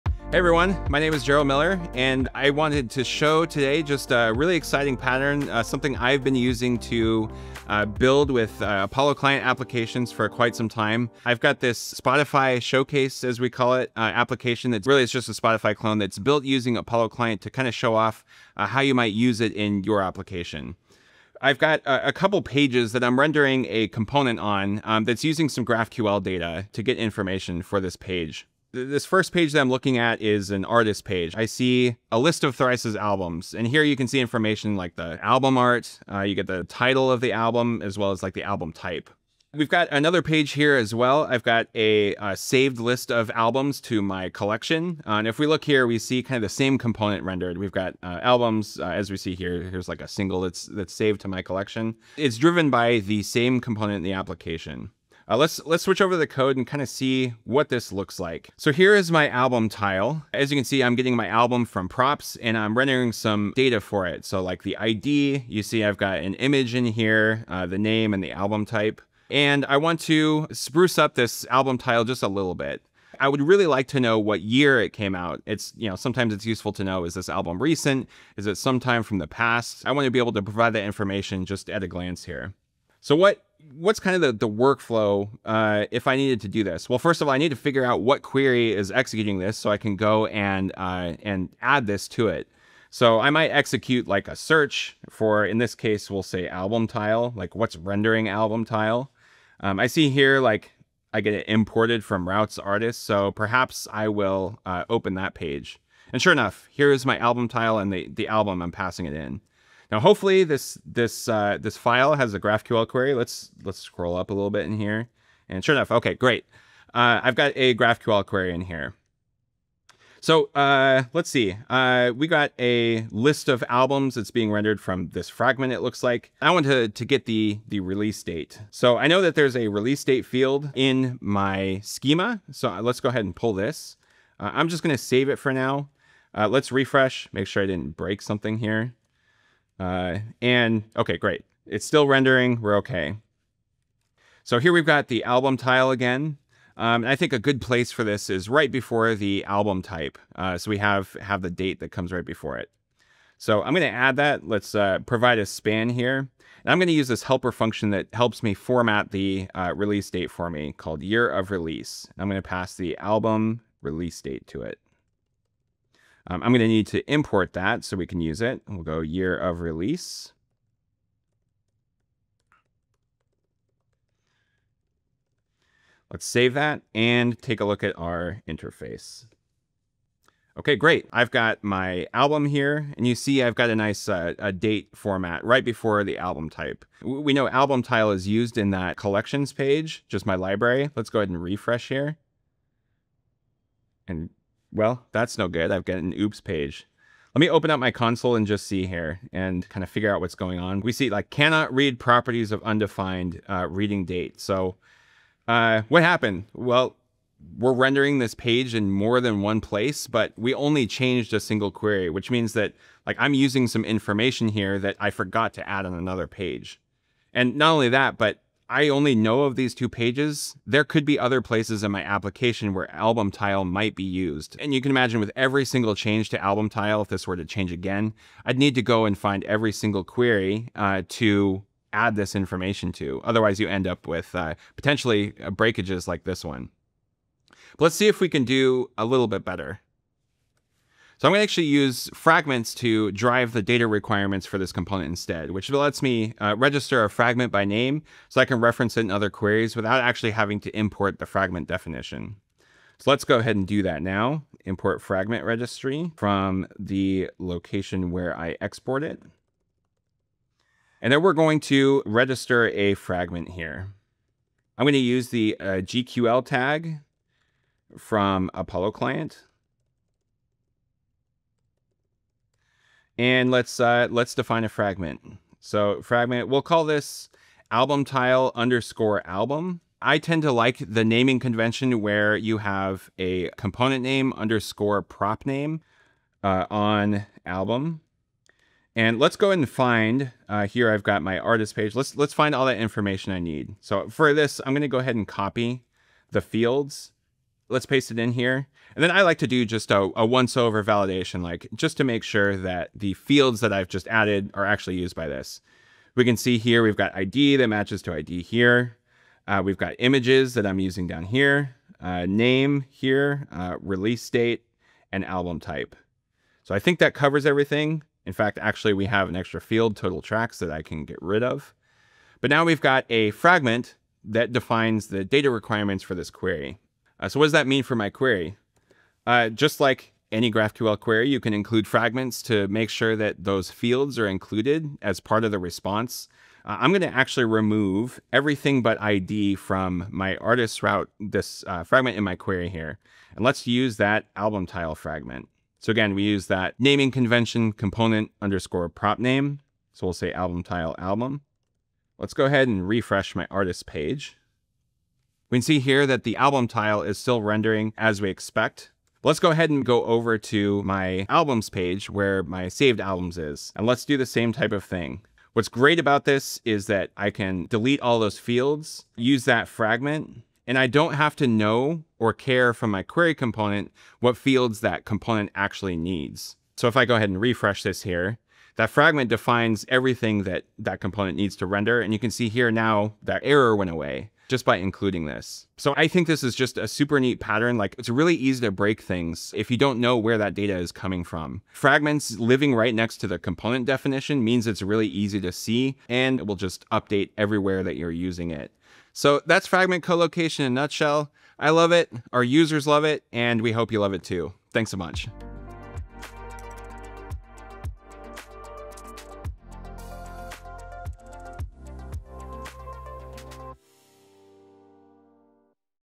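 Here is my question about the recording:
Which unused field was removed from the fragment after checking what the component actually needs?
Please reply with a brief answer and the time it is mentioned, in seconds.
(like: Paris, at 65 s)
total tracks, at 319 s.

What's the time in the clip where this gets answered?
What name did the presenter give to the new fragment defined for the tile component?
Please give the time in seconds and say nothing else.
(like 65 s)
277 s.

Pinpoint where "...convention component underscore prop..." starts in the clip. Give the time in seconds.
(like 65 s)
347 s.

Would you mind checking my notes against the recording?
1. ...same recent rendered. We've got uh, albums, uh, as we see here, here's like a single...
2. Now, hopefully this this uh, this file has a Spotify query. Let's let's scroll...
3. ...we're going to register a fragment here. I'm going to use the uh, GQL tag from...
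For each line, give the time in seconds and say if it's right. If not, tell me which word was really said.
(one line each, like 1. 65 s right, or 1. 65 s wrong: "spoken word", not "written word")
1. 46 s wrong: "component", not "recent"
2. 109 s wrong: "GraphQL", not "Spotify"
3. 261 s right.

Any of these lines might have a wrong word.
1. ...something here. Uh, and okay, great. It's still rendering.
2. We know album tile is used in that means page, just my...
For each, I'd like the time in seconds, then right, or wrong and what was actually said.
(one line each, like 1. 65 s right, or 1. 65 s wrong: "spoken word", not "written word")
1. 138 s right
2. 187 s wrong: "collections", not "means".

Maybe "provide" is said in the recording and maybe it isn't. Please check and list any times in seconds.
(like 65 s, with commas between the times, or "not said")
80 s, 155 s.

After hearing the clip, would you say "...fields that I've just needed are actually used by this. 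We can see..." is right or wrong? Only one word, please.
wrong.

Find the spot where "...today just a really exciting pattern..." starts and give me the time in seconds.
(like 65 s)
3 s.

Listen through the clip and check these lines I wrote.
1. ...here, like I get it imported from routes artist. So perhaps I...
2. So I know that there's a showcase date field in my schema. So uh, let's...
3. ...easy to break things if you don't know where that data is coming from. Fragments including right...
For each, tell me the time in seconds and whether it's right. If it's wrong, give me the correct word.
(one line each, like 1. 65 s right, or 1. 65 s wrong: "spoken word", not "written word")
1. 100 s right
2. 128 s wrong: "release", not "showcase"
3. 388 s wrong: "living", not "including".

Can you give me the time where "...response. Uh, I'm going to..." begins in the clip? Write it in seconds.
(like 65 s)
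335 s.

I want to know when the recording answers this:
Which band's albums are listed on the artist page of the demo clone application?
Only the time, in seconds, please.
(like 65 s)
32 s.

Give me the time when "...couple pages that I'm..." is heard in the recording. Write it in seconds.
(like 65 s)
22 s.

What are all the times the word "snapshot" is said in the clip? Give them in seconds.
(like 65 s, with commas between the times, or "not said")
not said.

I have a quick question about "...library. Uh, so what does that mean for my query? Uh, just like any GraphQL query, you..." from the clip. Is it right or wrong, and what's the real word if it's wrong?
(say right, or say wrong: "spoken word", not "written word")
wrong: "query", not "library".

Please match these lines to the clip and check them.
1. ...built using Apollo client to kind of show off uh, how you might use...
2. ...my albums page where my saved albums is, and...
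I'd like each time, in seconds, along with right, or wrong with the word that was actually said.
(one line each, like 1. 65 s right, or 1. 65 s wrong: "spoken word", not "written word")
1. 16 s right
2. 360 s right.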